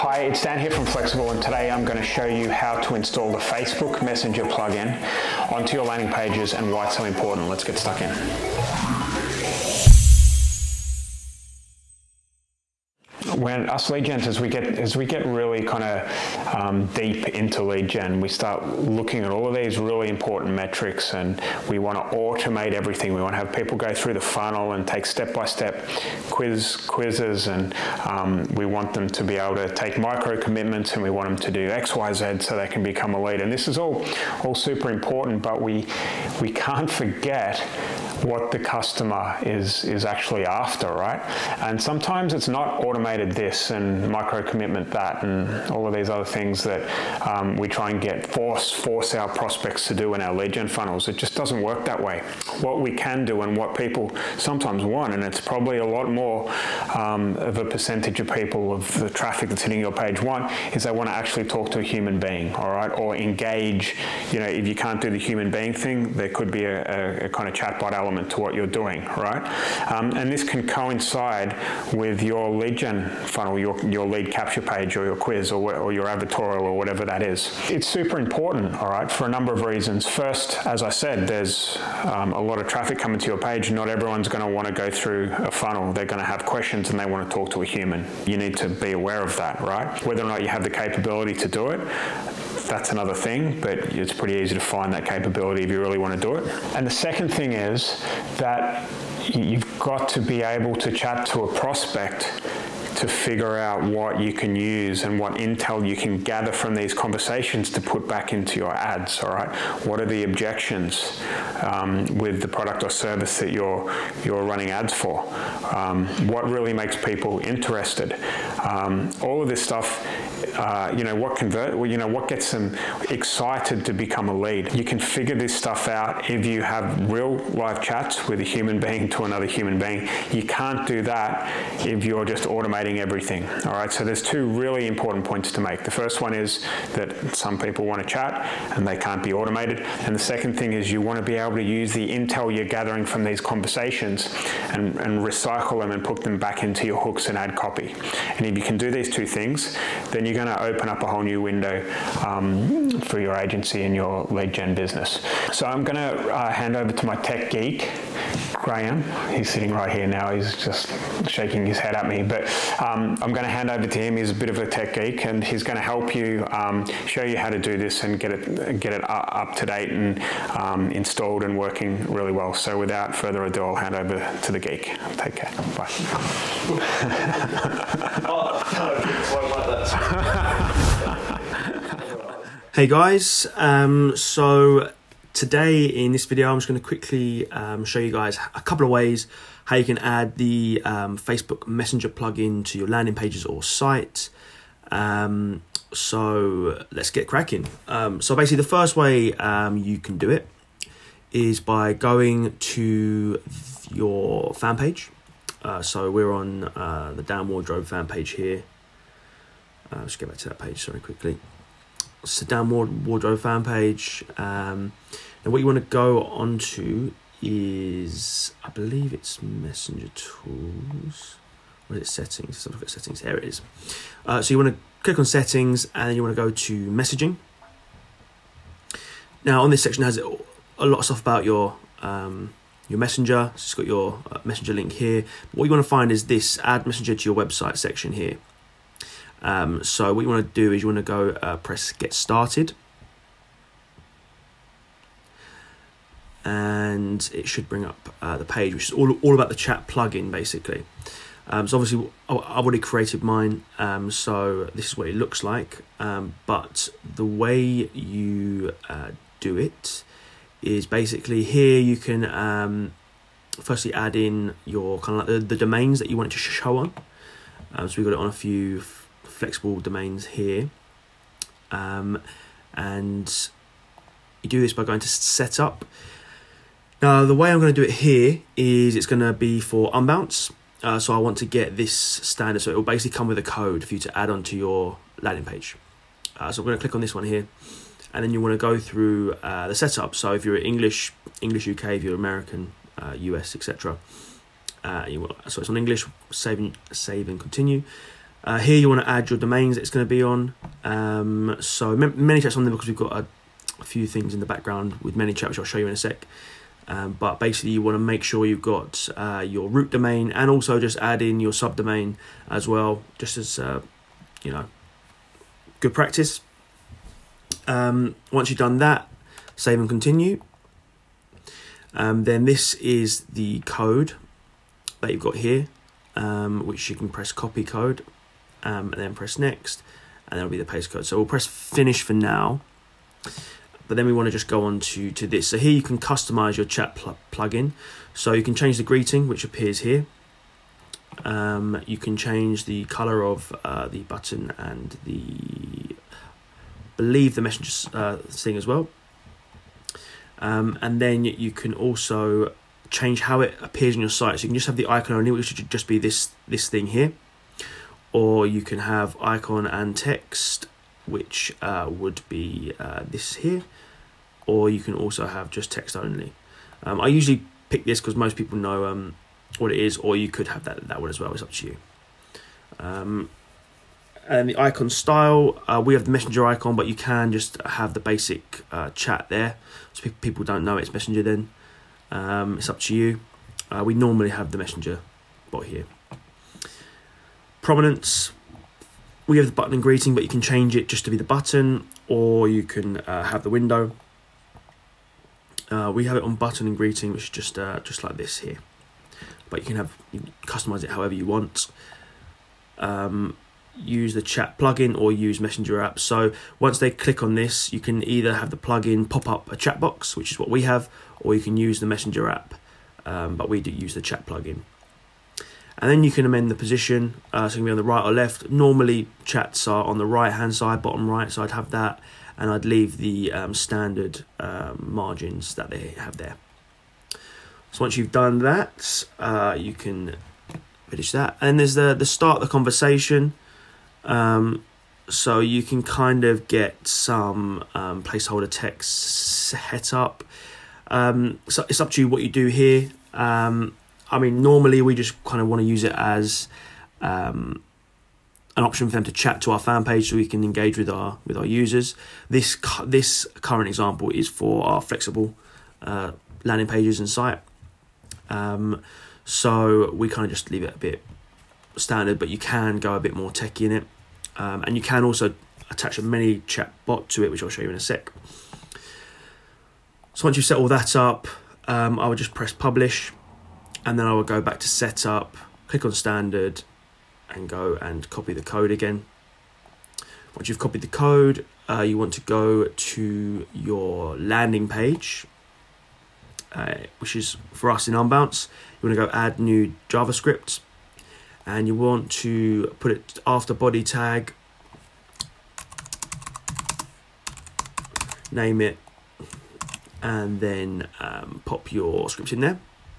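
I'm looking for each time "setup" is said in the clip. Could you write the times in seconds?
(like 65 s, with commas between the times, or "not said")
275 s, 289 s, 474 s.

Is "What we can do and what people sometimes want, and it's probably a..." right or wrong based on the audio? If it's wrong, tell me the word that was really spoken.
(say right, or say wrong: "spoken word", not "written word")
right.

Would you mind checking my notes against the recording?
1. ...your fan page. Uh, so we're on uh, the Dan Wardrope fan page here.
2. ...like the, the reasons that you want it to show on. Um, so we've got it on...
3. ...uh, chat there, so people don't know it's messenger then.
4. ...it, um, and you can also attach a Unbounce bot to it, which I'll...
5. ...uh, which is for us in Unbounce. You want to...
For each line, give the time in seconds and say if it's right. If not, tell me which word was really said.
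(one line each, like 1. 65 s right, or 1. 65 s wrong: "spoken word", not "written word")
1. 203 s right
2. 265 s wrong: "domains", not "reasons"
3. 378 s right
4. 463 s wrong: "ManyChat", not "Unbounce"
5. 486 s right.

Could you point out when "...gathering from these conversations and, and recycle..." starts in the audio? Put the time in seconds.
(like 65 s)
142 s.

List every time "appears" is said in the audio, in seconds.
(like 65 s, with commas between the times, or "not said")
339 s, 353 s.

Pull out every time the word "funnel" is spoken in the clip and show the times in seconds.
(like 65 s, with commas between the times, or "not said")
24 s, 50 s, 73 s, 85 s.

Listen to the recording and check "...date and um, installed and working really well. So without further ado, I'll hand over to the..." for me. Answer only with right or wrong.
right.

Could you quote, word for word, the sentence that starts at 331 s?
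So we'll press finish for now but then we want to just go on to, to this.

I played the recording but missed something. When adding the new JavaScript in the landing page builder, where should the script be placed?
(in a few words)
after body tag.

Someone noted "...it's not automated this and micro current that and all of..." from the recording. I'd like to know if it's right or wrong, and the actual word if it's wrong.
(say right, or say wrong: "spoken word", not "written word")
wrong: "commitment", not "current".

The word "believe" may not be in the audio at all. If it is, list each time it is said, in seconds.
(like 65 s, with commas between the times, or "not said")
218 s, 346 s.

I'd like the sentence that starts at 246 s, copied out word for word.
and it should bring up uh, the page, which is all, all about the chat plugin basically.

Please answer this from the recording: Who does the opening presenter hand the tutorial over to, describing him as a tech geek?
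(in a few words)
Graham.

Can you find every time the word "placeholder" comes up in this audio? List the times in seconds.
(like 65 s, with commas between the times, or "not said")
438 s.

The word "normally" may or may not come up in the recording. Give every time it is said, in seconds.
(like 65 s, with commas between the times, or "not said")
383 s, 418 s, 444 s.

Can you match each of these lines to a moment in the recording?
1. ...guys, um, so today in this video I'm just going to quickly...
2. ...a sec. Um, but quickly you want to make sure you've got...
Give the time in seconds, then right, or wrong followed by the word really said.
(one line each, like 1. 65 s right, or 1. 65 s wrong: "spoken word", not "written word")
1. 182 s right
2. 305 s wrong: "basically", not "quickly".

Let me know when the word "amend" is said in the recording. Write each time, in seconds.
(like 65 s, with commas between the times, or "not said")
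416 s.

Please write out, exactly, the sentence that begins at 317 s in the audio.
Um, once you've done that, save and continue.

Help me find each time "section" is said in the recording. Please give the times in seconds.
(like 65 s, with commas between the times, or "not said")
229 s, 237 s.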